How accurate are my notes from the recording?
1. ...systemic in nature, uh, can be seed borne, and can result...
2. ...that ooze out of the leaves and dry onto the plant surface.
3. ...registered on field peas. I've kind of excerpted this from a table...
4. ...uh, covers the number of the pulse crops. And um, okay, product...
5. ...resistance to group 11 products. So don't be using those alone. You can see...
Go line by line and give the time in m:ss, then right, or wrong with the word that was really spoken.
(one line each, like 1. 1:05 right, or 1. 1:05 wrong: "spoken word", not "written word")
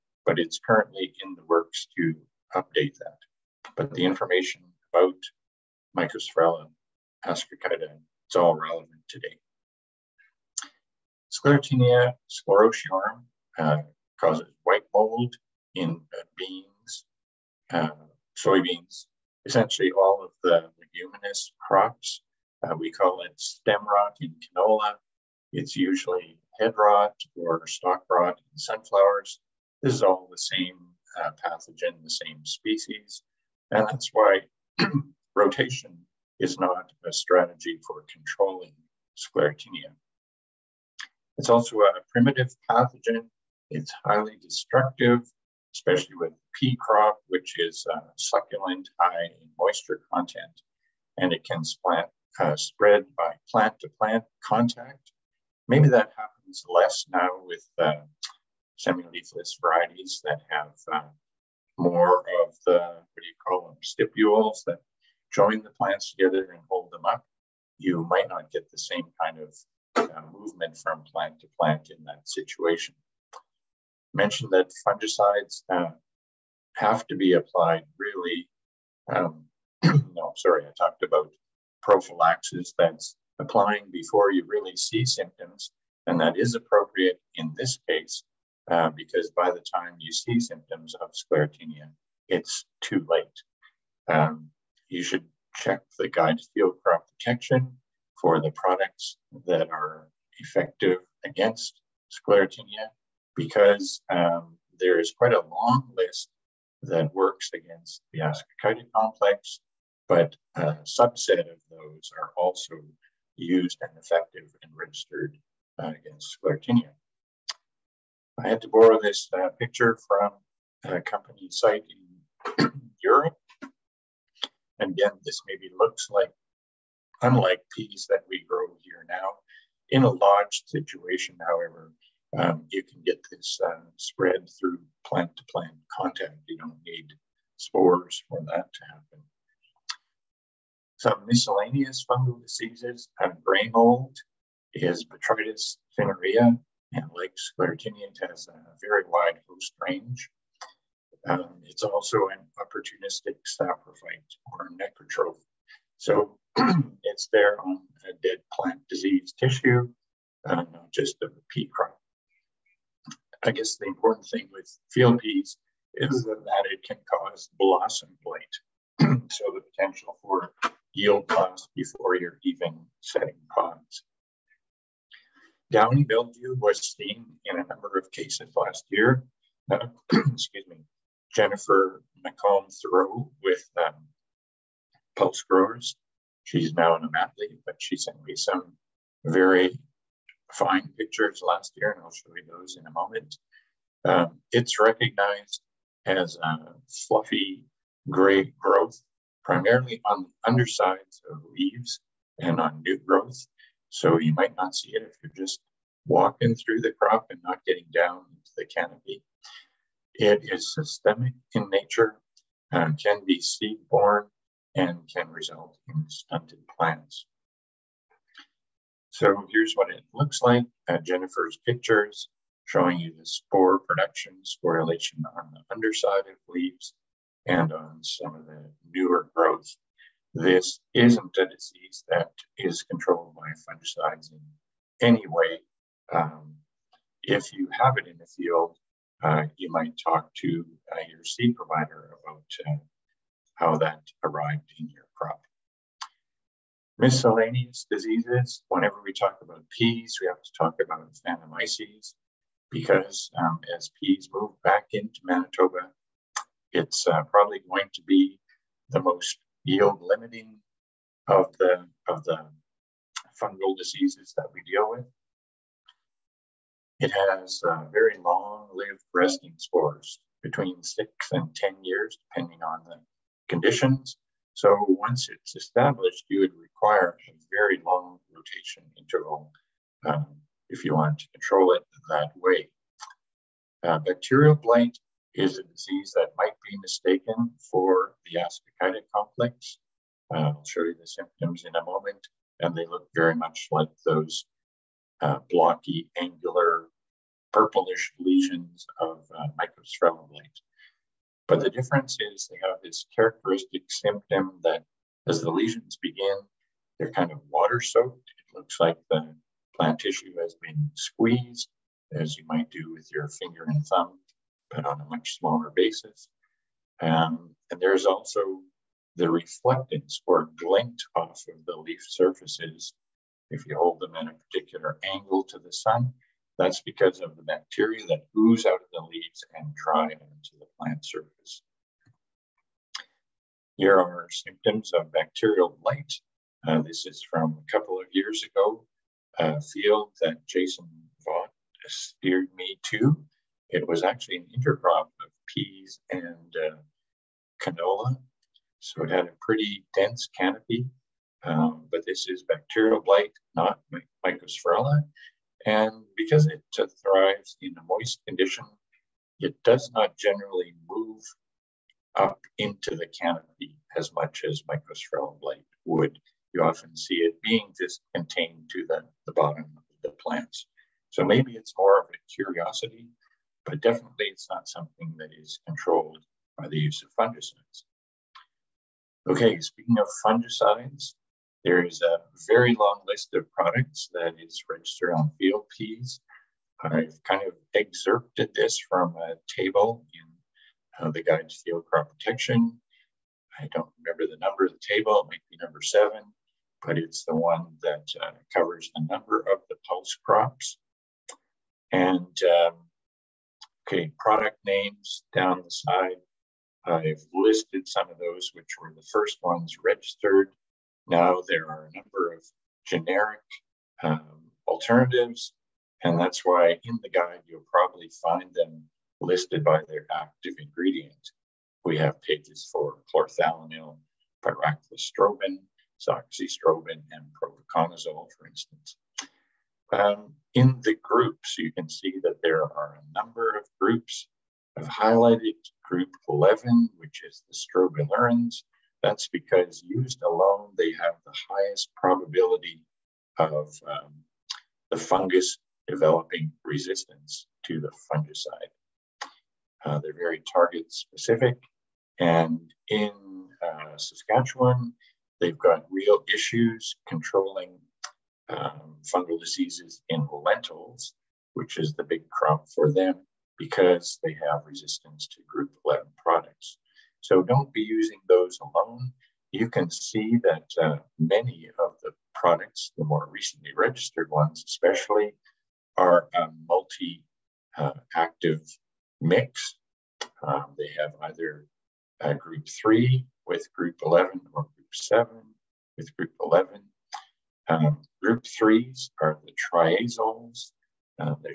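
1. 3:30 right
2. 5:28 right
3. 6:24 right
4. 6:38 right
5. 7:44 right.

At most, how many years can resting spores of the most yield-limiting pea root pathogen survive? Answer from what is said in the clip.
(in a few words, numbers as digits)
10.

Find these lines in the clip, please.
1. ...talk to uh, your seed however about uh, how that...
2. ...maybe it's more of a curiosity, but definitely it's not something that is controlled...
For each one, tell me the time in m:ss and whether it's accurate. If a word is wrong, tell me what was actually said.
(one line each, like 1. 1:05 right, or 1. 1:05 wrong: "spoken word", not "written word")
1. 4:00 wrong: "provider", not "however"
2. 6:11 right.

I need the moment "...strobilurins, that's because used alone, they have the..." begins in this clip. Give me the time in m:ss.
7:17.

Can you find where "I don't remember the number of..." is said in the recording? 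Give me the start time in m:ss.
6:33.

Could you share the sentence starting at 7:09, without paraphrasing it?
Um, in the groups, you can see that there are a number of groups.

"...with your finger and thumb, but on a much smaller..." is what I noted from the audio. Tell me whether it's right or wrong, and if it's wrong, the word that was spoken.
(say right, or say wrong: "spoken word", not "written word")
right.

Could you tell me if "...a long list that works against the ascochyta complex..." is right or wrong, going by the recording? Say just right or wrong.
right.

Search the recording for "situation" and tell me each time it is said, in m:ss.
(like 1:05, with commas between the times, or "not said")
1:12, 2:10.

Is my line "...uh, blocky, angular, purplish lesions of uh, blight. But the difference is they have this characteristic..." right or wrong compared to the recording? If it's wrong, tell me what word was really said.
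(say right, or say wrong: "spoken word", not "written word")
right.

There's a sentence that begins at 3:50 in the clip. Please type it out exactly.
This isn't a disease that is controlled by fungicides in any way.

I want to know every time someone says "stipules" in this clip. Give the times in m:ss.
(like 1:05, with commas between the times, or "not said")
1:03.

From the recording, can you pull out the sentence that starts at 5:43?
It was actually an intercrop of peas and uh, canola.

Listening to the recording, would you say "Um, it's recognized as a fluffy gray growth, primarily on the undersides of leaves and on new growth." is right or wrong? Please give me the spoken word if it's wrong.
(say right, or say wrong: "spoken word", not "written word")
right.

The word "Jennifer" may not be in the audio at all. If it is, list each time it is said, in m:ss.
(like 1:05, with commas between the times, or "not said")
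3:01, 3:41.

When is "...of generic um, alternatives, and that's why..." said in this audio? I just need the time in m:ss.
6:52.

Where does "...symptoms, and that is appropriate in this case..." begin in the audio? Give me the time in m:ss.
1:25.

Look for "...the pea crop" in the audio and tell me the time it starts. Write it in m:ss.
2:41.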